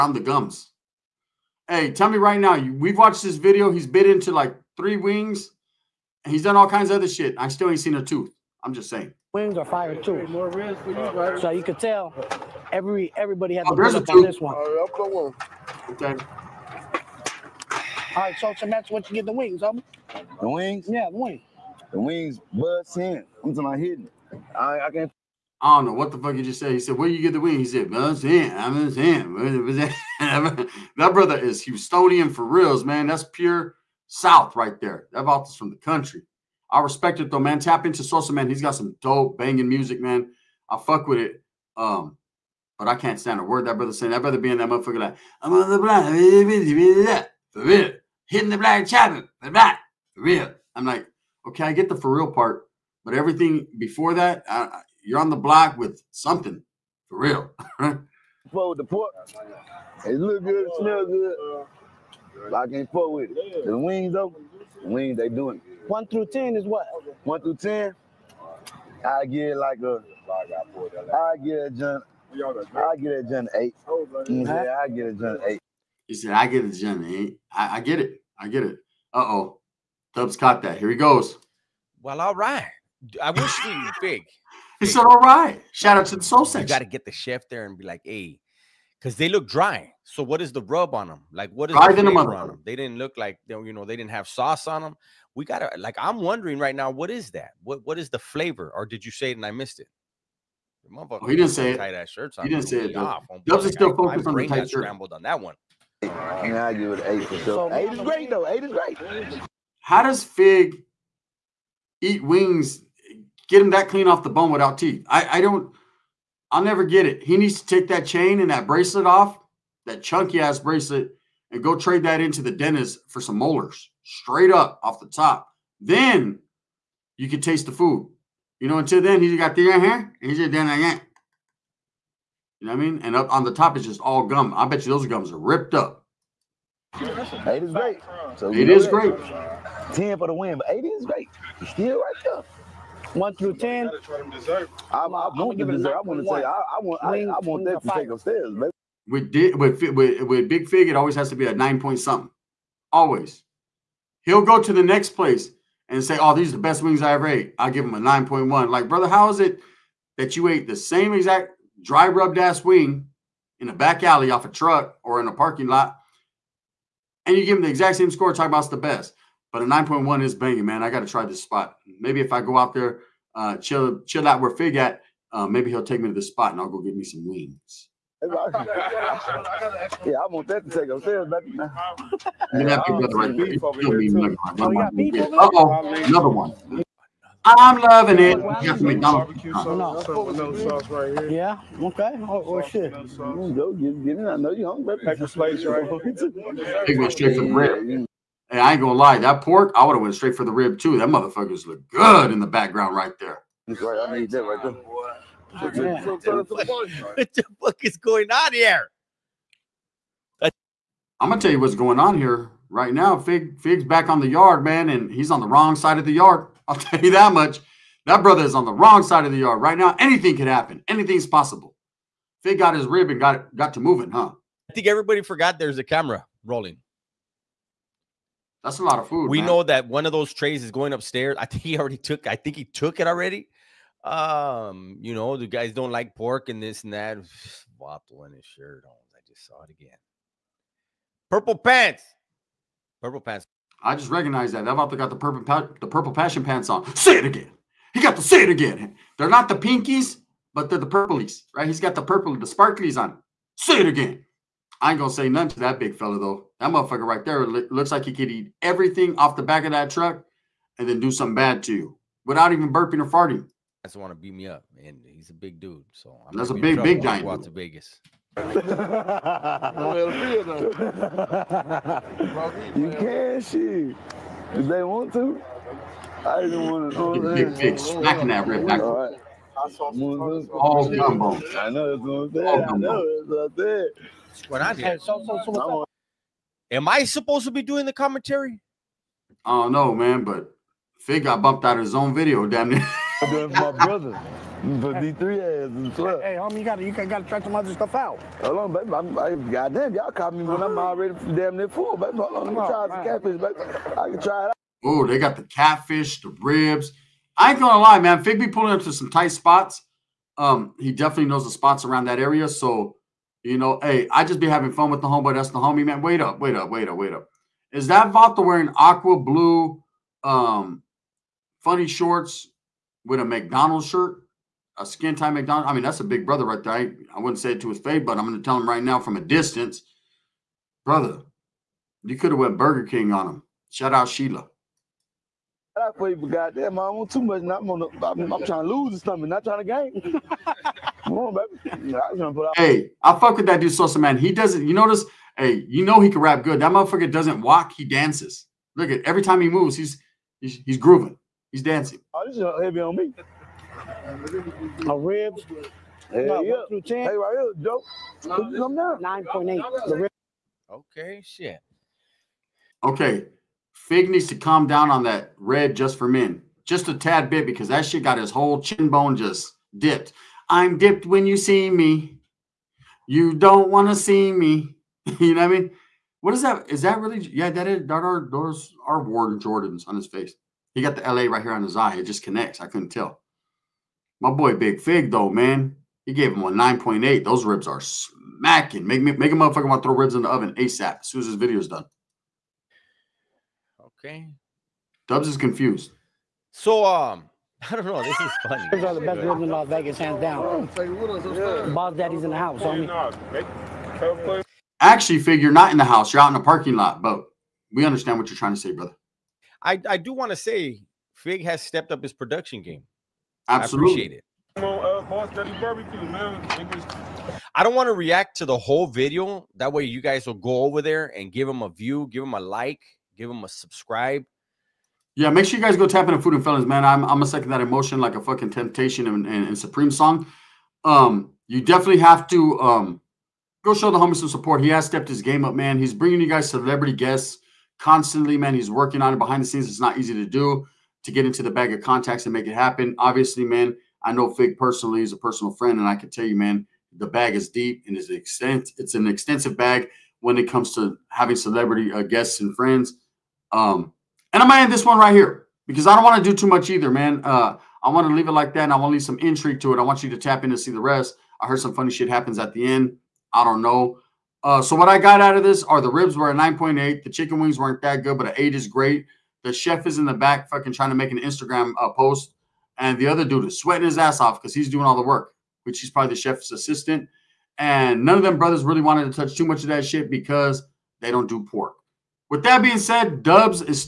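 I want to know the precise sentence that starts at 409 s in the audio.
I, I do want to say Fig has stepped up his production game.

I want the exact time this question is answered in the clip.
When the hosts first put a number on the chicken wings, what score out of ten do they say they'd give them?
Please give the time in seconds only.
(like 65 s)
106 s.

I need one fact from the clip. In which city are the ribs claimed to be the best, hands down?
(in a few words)
Las Vegas.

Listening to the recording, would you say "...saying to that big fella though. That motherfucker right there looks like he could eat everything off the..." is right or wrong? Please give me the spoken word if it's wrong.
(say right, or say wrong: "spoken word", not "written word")
wrong: "nothing", not "saying".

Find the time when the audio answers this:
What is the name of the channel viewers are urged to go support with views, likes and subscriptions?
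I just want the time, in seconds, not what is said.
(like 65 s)
426 s.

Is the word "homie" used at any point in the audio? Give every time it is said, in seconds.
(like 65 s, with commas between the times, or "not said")
296 s, 315 s, 402 s, 433 s.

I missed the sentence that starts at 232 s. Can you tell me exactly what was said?
I think he took it already.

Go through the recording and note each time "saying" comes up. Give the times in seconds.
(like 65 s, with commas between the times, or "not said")
8 s, 28 s, 43 s.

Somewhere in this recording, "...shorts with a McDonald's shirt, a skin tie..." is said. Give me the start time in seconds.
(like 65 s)
321 s.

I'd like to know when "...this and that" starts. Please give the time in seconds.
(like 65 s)
236 s.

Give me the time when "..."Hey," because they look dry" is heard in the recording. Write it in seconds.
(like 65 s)
88 s.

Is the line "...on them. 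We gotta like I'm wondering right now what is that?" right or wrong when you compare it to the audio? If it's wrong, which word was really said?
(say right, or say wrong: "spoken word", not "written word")
right.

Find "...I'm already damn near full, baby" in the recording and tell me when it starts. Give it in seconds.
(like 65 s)
300 s.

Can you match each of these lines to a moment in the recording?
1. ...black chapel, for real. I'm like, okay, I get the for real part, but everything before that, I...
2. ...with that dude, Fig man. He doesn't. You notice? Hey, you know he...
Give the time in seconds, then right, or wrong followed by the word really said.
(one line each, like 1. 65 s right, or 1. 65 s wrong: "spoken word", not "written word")
1. 48 s right
2. 343 s wrong: "Sosa", not "Fig".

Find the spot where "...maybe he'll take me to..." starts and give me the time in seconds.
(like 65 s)
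175 s.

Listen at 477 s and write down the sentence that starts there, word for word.
And none of them brothers really wanted to touch too much of that shit because they don't do pork.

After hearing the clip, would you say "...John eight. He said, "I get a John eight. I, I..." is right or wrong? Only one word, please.
right.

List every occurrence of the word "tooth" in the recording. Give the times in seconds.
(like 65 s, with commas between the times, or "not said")
8 s.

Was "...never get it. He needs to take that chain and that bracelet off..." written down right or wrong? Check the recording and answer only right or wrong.
right.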